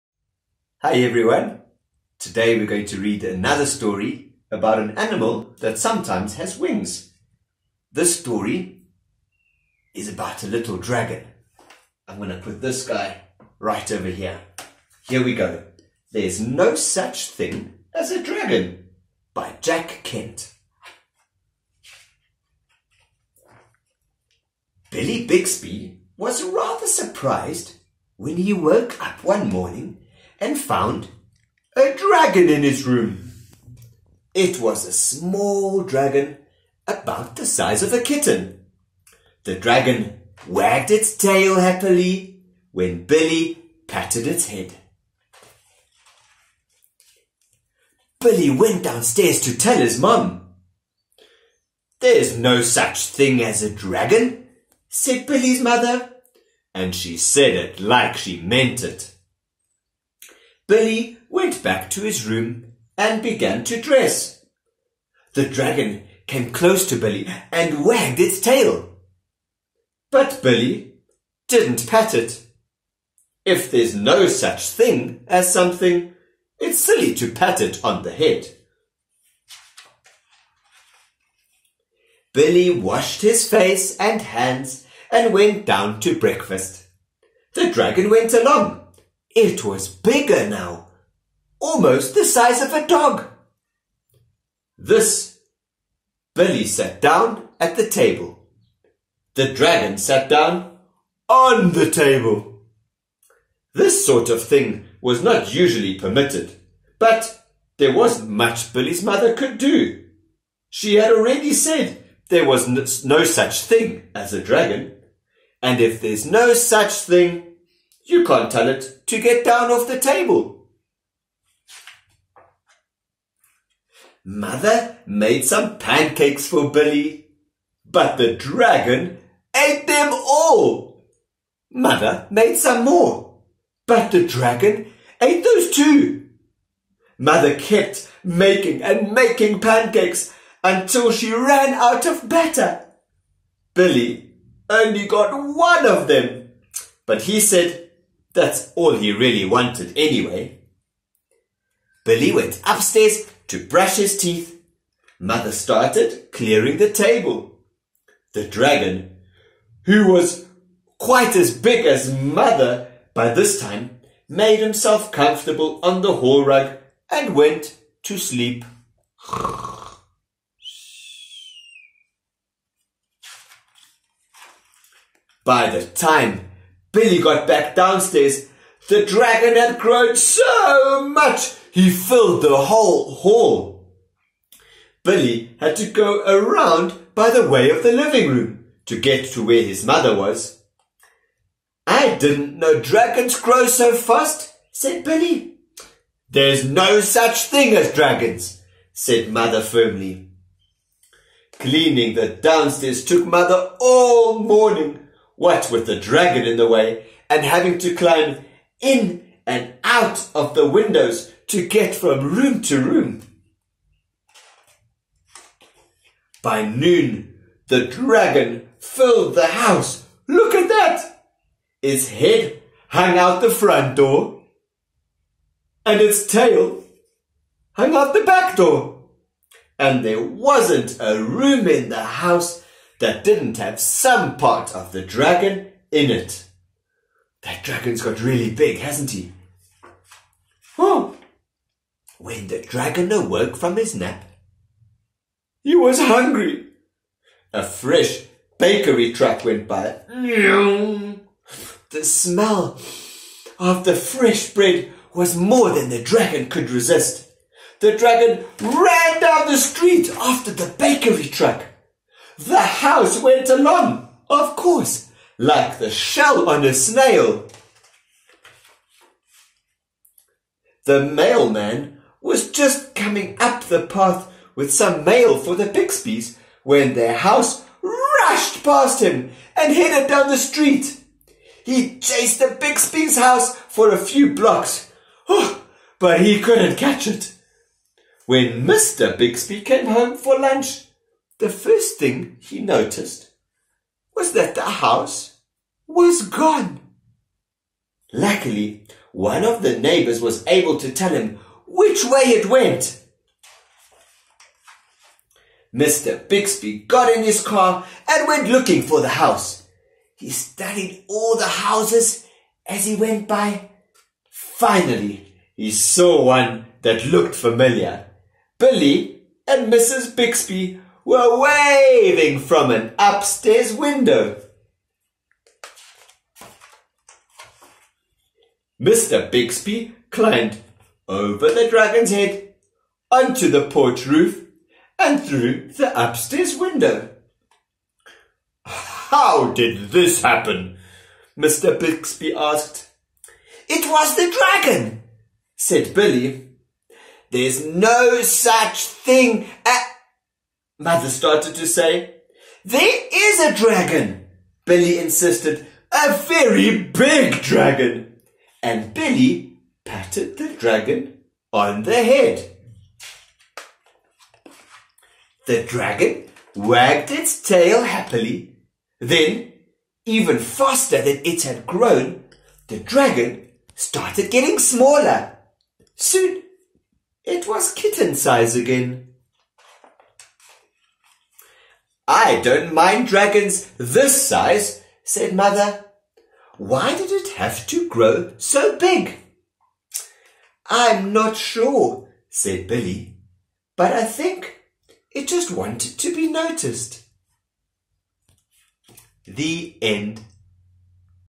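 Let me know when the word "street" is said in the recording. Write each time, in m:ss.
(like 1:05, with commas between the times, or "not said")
4:19, 4:40.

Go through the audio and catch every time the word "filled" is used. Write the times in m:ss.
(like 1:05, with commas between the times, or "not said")
3:01, 3:38.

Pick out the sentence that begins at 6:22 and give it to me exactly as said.
I don't mind dragons this size, said Mother.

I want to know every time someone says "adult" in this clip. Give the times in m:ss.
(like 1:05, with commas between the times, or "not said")
not said.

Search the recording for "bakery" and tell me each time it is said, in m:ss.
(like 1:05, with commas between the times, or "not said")
4:08, 4:20.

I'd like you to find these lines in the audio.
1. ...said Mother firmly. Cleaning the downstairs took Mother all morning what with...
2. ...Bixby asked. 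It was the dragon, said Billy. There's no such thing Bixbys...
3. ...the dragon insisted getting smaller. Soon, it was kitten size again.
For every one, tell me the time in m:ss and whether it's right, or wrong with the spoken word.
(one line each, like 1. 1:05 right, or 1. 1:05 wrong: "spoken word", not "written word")
1. 3:18 right
2. 5:41 wrong: "Mother", not "Bixbys"
3. 6:12 wrong: "started", not "insisted".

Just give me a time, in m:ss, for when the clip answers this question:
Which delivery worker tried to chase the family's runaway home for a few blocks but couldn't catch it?
4:31.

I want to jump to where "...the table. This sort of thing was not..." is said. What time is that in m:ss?
1:41.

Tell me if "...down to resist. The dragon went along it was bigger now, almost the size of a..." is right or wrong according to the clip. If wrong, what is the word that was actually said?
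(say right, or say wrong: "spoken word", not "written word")
wrong: "breakfast", not "resist".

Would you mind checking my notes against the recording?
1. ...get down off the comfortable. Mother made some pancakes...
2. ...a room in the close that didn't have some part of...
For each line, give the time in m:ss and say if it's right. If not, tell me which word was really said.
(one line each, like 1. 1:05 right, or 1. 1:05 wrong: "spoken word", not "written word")
1. 1:59 wrong: "table", not "comfortable"
2. 3:50 wrong: "house", not "close".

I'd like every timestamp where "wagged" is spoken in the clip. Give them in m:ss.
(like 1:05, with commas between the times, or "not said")
0:40, 1:07, 6:06.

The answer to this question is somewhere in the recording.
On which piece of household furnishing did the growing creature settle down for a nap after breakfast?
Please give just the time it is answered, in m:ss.
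2:46.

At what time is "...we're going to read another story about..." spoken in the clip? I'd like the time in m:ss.
0:02.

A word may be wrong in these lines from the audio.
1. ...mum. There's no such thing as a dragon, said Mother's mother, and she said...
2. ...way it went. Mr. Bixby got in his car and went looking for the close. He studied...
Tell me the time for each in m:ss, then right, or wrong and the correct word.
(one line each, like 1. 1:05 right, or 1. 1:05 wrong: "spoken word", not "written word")
1. 0:49 wrong: "Billy", not "Mother"
2. 5:02 wrong: "house", not "close".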